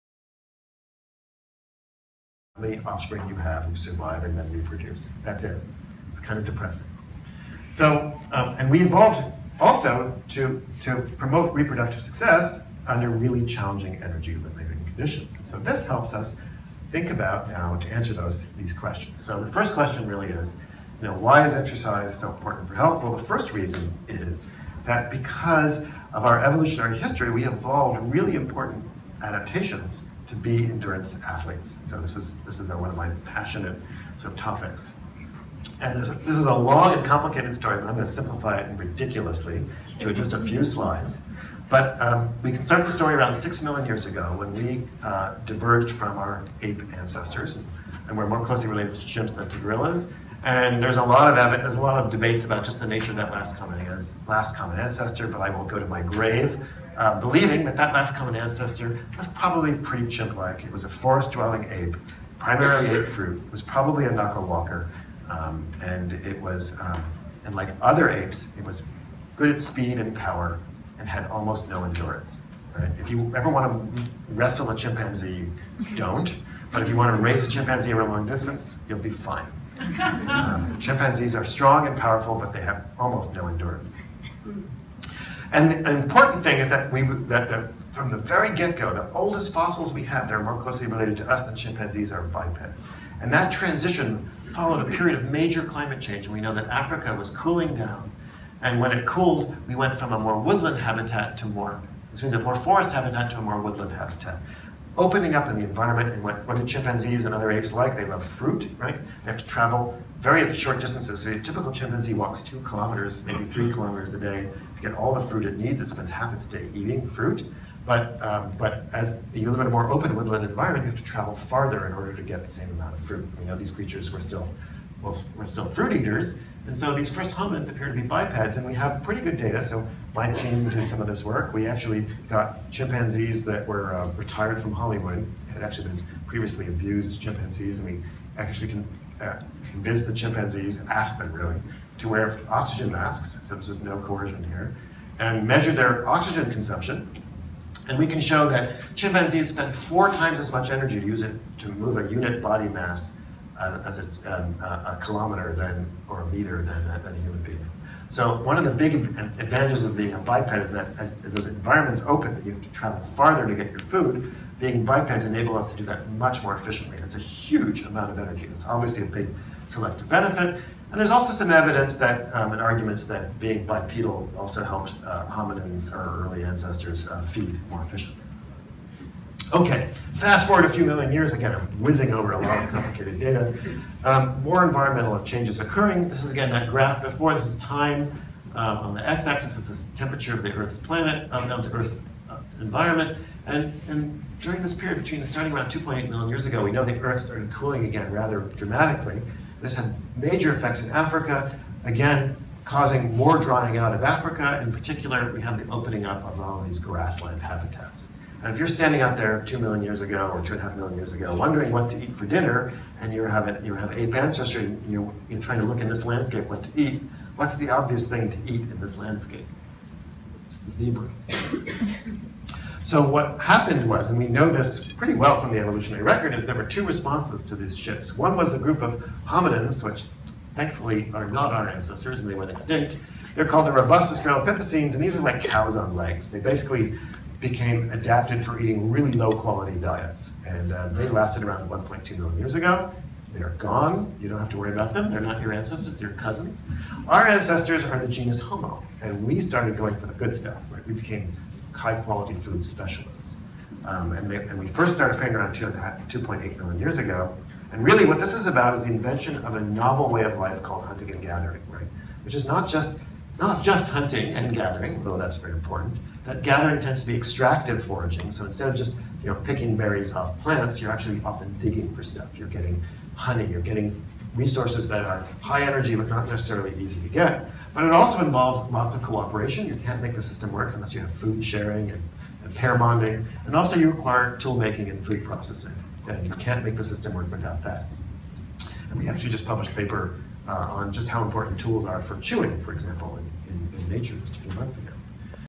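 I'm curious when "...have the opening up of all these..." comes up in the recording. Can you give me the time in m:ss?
3:25.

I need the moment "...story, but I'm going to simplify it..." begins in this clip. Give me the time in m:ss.
0:37.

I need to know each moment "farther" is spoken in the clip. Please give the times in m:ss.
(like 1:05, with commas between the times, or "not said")
2:01, 2:43.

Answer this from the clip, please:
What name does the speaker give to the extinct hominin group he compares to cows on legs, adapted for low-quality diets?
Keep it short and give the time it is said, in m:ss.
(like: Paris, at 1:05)
robust Australopithecines, at 3:53.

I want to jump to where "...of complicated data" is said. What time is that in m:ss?
3:02.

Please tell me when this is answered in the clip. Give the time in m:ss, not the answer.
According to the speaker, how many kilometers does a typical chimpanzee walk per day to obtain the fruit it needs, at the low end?
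1:52.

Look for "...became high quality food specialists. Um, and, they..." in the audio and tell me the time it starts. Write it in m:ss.
4:10.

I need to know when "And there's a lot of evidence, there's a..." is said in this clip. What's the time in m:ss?
0:50.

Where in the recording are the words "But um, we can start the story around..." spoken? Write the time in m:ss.
0:41.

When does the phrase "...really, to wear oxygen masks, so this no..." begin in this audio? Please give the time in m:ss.
2:21.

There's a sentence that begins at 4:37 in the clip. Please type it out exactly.
But it also involves lots of cooperation.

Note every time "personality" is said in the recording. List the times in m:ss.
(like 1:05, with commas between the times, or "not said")
not said.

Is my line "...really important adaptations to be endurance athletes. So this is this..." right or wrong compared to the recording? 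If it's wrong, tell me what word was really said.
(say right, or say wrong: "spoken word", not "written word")
right.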